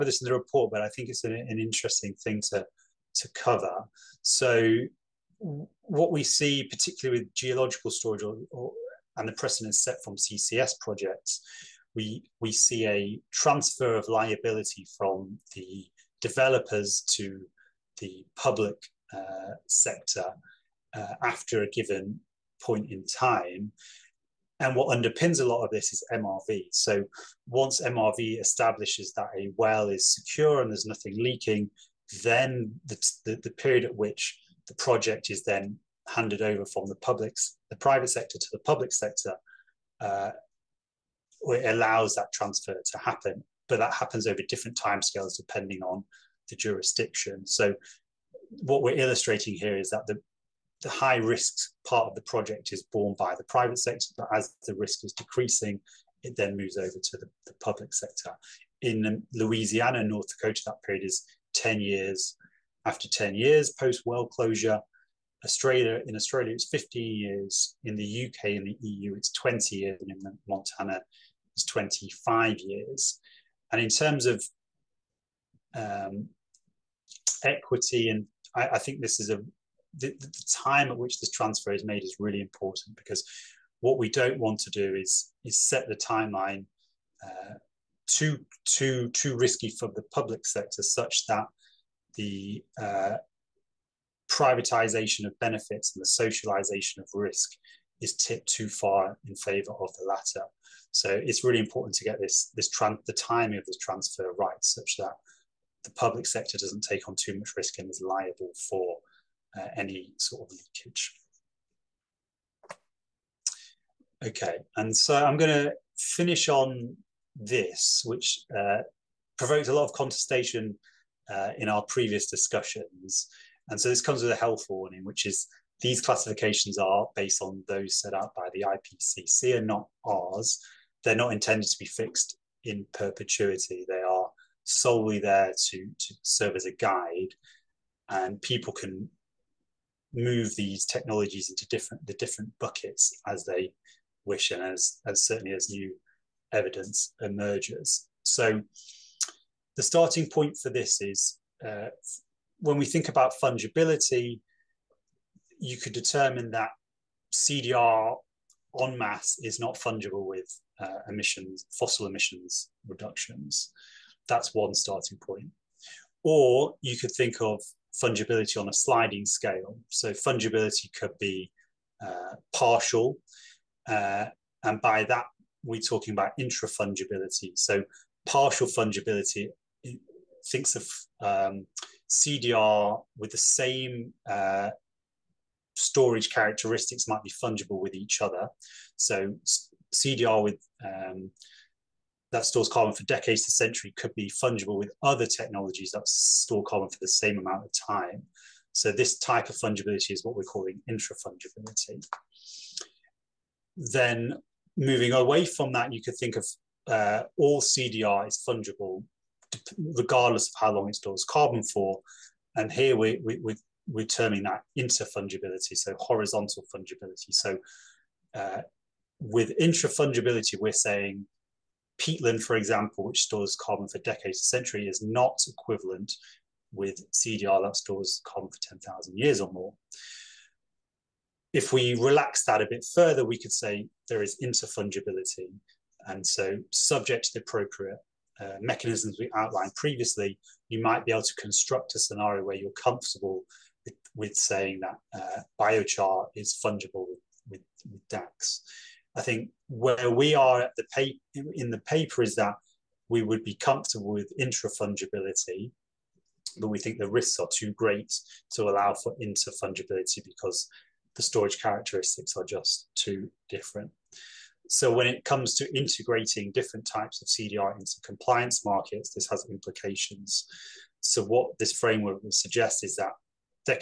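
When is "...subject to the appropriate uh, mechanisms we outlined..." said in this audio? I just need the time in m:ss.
3:56.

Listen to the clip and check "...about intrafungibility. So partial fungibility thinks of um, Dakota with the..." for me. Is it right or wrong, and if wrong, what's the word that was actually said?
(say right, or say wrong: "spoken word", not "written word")
wrong: "CDR", not "Dakota".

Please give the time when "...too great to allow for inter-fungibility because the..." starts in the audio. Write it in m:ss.
4:17.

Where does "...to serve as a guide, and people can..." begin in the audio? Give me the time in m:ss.
2:15.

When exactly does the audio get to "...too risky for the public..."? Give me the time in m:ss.
1:29.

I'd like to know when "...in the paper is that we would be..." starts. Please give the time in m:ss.
4:11.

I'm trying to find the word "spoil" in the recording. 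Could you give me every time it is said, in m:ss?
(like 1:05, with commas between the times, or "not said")
not said.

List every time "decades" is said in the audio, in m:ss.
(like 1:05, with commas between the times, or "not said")
3:13, 3:43.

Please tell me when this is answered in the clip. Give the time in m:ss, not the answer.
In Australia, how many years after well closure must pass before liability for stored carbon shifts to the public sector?
1:06.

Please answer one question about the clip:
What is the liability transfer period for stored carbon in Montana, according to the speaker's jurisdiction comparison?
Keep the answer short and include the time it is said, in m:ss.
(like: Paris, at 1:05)
25 years, at 1:11.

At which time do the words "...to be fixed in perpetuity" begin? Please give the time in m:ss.
2:11.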